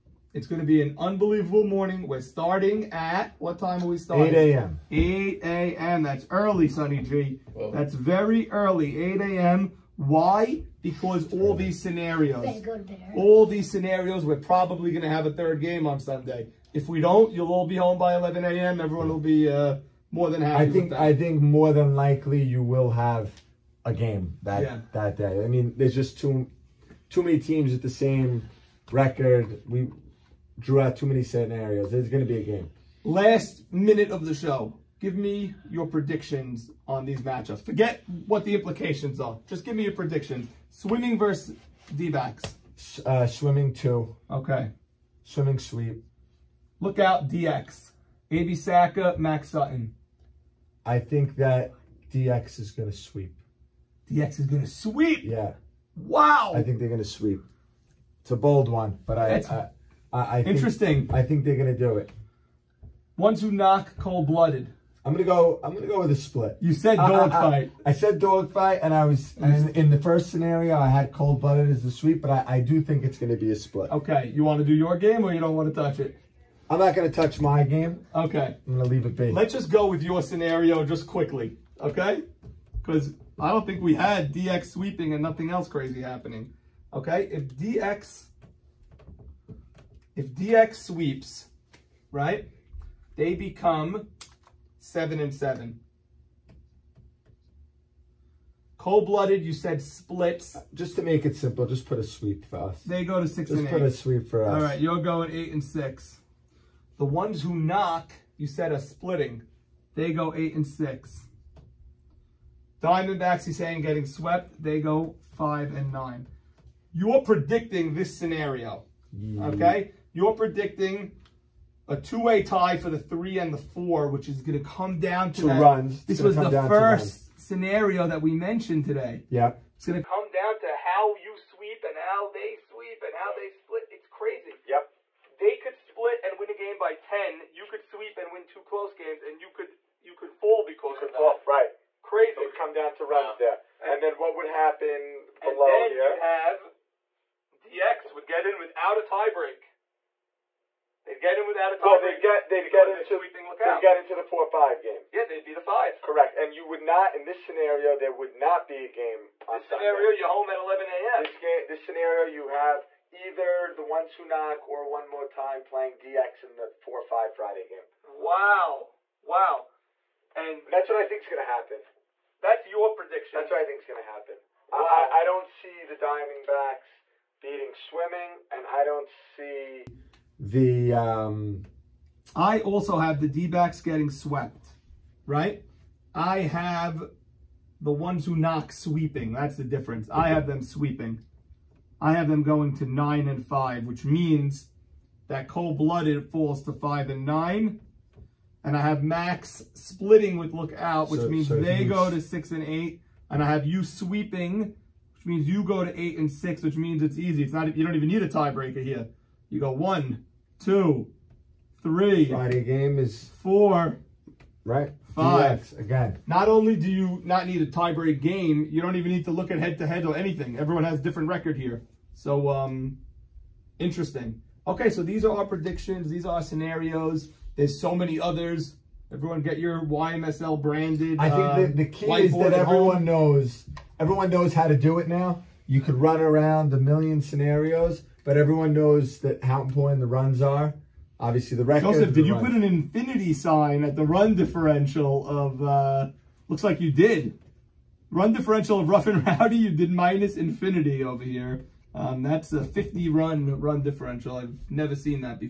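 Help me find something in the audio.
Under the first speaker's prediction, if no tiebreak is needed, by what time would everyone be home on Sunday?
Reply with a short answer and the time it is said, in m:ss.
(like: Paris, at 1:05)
11 a.m., at 2:40.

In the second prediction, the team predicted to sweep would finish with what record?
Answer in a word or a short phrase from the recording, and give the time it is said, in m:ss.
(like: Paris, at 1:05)
9 and 5, at 3:12.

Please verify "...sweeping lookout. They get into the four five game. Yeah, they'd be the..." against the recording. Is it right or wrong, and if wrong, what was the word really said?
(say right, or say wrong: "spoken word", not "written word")
right.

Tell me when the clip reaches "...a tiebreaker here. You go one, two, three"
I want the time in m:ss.
3:28.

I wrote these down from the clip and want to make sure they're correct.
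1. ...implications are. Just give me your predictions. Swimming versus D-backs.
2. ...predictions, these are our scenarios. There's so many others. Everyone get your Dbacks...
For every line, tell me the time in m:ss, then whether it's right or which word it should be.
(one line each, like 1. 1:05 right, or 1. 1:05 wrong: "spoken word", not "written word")
1. 0:38 right
2. 3:45 wrong: "YMSL", not "Dbacks".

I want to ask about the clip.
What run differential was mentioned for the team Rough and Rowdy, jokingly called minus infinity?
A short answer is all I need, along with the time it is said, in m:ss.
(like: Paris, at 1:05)
50 runs, at 4:12.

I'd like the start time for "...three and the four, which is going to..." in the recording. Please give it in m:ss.
2:02.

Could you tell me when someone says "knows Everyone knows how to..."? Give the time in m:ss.
3:53.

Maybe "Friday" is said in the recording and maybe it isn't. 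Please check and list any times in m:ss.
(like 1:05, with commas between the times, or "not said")
2:47, 3:32.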